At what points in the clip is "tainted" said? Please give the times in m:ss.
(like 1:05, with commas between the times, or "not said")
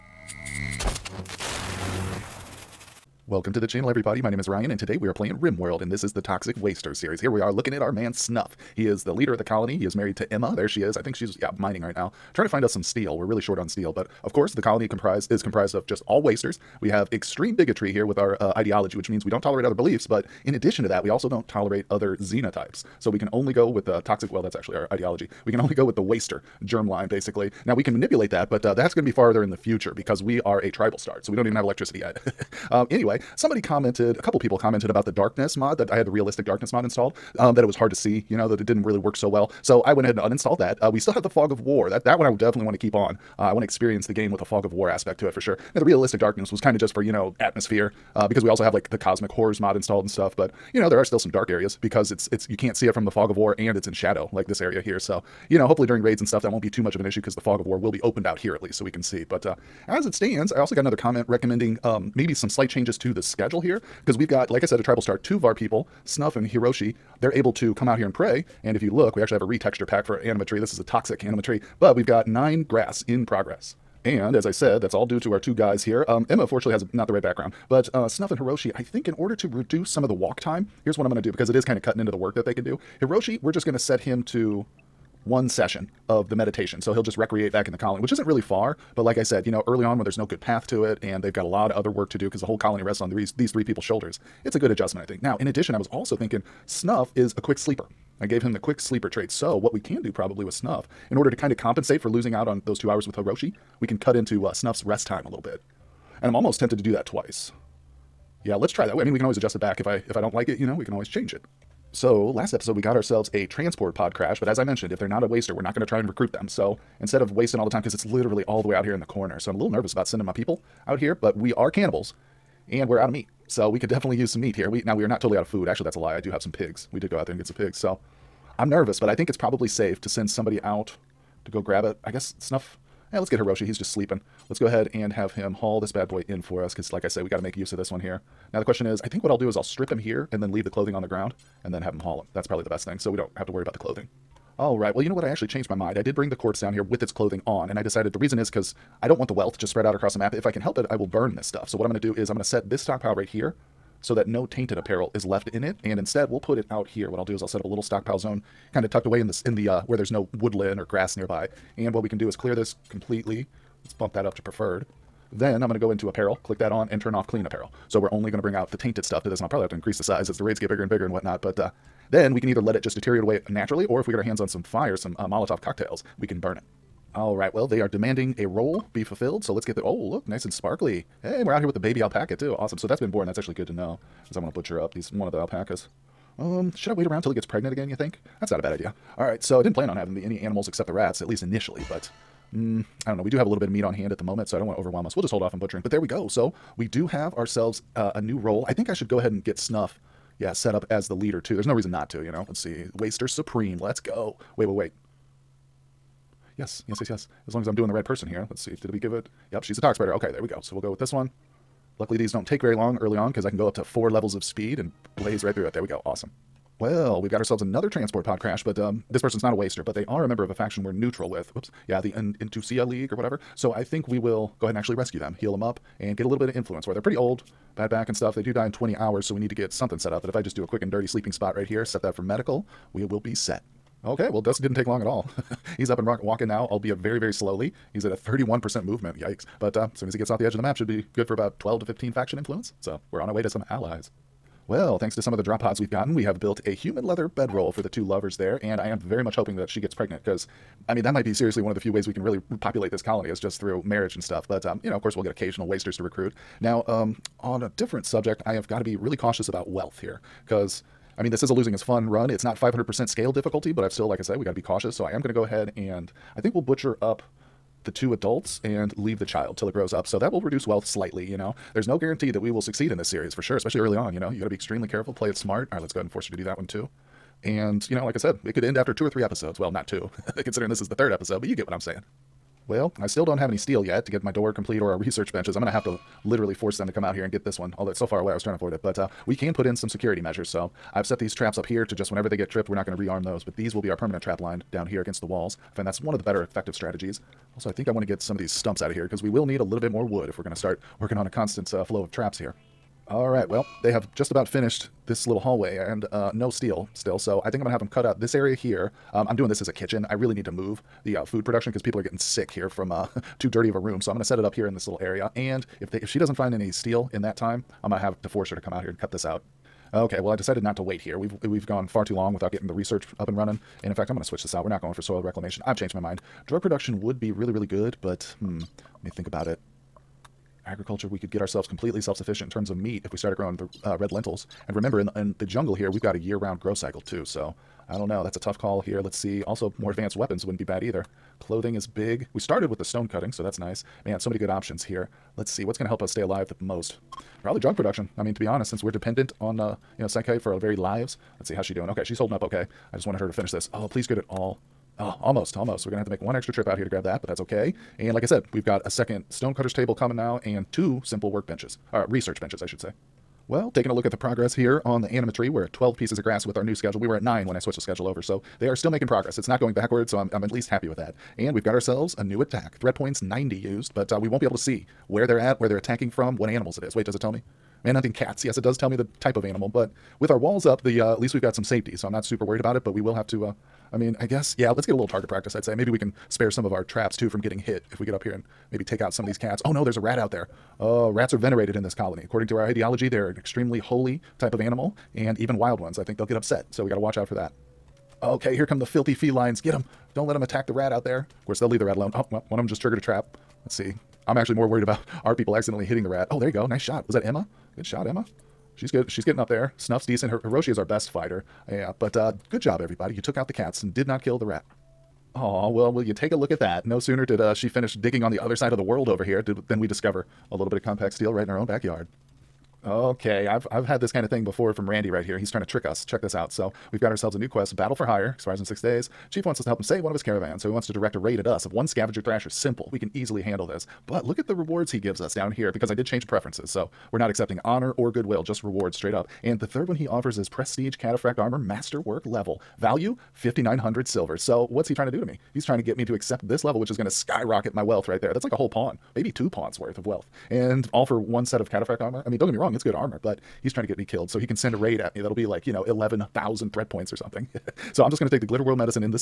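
2:34, 2:48.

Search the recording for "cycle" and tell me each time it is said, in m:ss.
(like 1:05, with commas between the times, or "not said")
5:36.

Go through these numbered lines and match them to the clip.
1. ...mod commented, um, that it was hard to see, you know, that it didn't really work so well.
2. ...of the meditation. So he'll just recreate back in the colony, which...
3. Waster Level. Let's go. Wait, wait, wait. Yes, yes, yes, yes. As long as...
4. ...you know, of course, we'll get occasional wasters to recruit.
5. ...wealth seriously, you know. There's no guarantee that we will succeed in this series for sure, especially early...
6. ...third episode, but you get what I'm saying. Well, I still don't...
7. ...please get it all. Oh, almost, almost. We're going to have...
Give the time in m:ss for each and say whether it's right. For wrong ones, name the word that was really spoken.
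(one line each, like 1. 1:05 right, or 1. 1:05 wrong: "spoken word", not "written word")
1. 0:36 wrong: "installed", not "commented"
2. 1:26 right
3. 3:22 wrong: "Supreme", not "Level"
4. 4:14 right
5. 4:30 wrong: "slightly", not "seriously"
6. 4:40 right
7. 5:53 right.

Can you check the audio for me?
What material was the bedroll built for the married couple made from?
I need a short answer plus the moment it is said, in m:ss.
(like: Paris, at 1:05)
Human leather, at 4:06.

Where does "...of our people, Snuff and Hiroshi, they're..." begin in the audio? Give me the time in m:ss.
1:05.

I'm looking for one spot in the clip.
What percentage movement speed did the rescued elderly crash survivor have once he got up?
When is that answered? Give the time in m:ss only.
3:58.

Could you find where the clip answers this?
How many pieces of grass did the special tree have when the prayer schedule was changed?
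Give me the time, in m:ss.
1:12.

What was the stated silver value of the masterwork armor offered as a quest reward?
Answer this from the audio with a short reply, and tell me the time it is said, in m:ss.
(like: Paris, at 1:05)
5,900 silver, at 7:23.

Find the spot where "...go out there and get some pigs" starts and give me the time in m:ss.
2:07.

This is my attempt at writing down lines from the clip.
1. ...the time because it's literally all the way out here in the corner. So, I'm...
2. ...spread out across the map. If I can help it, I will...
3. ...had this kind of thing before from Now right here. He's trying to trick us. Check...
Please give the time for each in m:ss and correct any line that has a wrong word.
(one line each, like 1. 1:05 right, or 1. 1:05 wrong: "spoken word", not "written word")
1. 1:57 right
2. 2:29 right
3. 7:03 wrong: "Randy", not "Now".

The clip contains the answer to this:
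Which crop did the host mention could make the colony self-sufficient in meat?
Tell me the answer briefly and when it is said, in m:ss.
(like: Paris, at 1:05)
Red lentils, at 5:33.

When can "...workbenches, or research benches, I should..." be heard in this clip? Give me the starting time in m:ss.
6:01.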